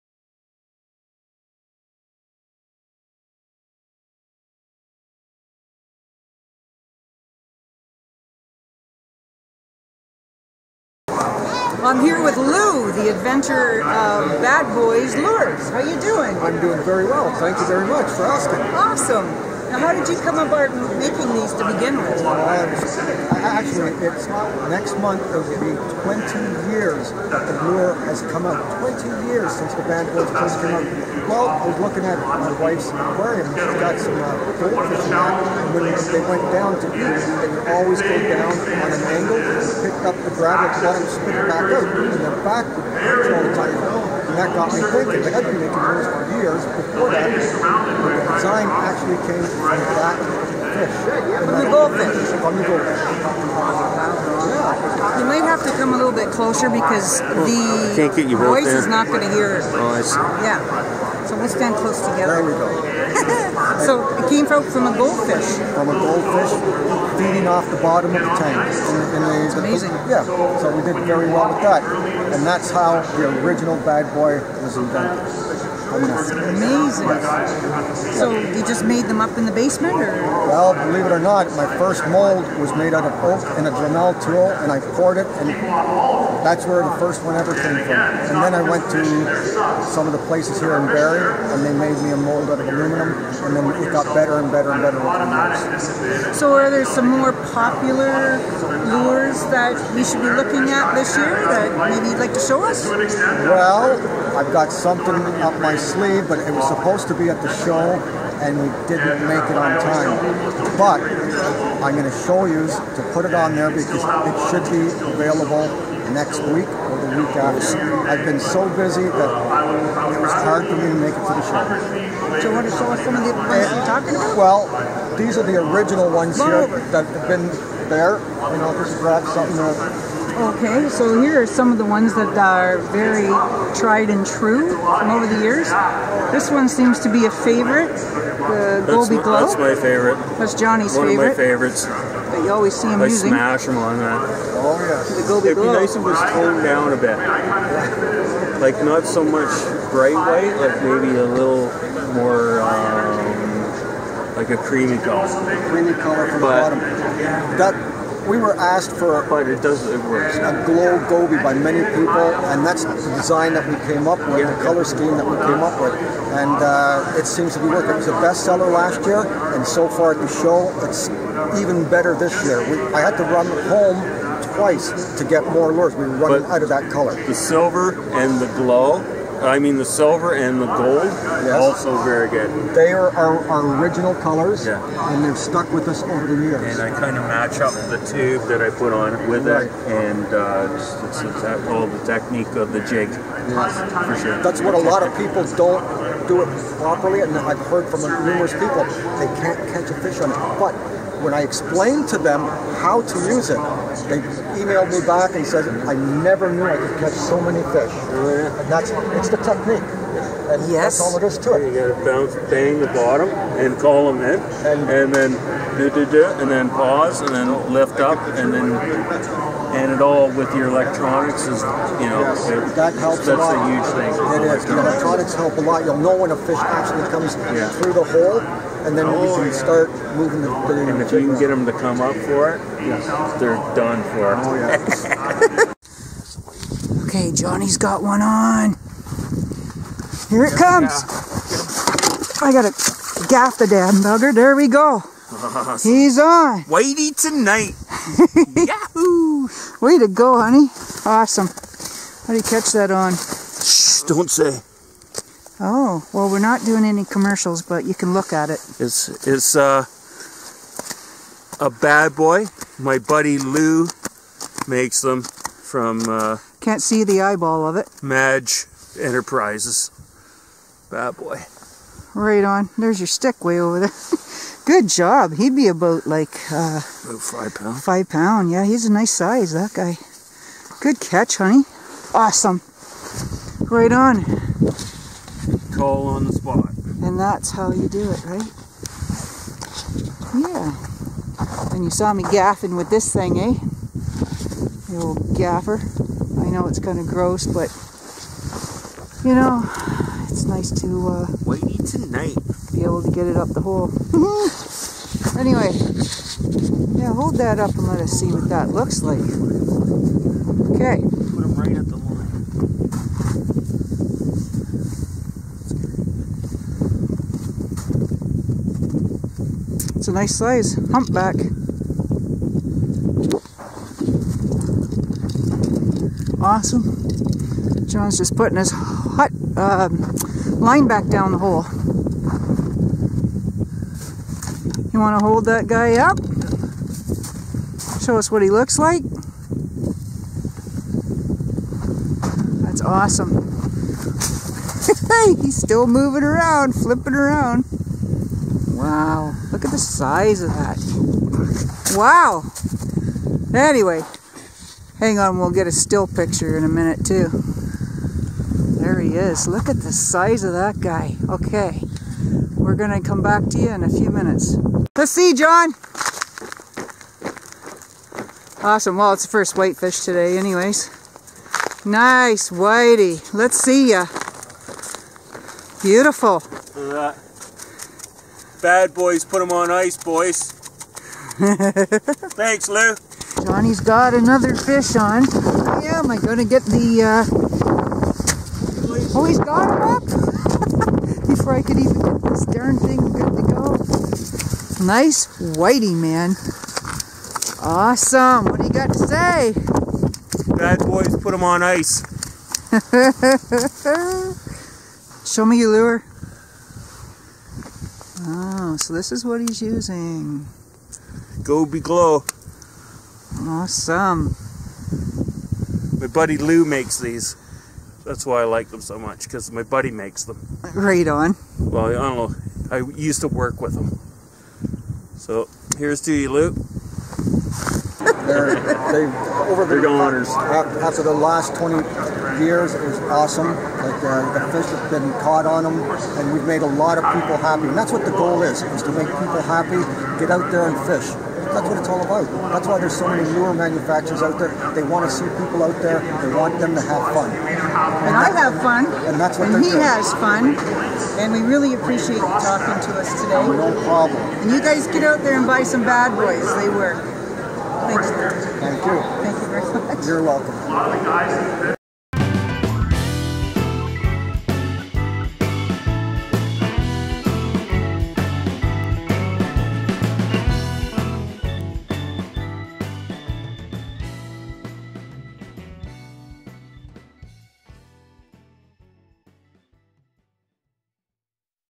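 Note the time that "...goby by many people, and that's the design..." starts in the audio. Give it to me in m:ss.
2:41.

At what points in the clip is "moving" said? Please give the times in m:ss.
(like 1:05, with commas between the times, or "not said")
3:50, 5:45.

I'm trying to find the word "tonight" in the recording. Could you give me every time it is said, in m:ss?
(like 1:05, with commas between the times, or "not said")
4:07, 5:01.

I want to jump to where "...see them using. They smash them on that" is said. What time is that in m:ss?
2:22.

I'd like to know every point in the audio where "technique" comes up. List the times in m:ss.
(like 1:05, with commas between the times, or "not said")
3:12, 3:29.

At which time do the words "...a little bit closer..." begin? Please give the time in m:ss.
0:55.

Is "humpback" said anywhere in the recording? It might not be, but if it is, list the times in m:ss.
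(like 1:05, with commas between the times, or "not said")
5:20.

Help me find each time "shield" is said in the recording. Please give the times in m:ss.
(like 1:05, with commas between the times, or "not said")
not said.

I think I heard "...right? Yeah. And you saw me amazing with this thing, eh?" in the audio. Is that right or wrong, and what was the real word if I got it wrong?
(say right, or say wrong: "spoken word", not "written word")
wrong: "gaffing", not "amazing".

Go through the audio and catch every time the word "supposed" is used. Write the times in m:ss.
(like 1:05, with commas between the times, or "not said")
1:46.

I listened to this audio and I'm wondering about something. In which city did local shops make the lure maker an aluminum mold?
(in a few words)
Barrie.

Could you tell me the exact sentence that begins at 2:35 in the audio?
Creamy color from but the bottom.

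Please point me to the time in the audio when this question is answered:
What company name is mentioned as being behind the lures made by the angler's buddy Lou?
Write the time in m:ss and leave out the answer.
4:28.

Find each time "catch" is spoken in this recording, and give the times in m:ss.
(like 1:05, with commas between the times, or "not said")
3:19, 3:26, 4:12, 4:41.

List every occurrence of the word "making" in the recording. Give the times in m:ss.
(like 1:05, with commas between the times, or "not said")
0:20, 0:45.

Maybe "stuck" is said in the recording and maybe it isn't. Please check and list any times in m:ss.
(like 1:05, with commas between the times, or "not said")
3:05.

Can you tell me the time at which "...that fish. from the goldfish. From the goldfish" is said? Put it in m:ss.
0:49.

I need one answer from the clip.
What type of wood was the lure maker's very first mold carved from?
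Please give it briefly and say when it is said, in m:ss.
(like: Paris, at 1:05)
Oak, at 1:23.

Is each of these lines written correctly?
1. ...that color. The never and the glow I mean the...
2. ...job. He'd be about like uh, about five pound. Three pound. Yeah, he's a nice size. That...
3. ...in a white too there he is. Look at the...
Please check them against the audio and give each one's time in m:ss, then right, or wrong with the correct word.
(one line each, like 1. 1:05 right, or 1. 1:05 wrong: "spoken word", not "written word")
1. 2:56 wrong: "silver", not "never"
2. 4:34 wrong: "Five", not "Three"
3. 5:56 wrong: "minute", not "white".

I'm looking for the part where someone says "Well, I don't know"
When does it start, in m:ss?
7:01.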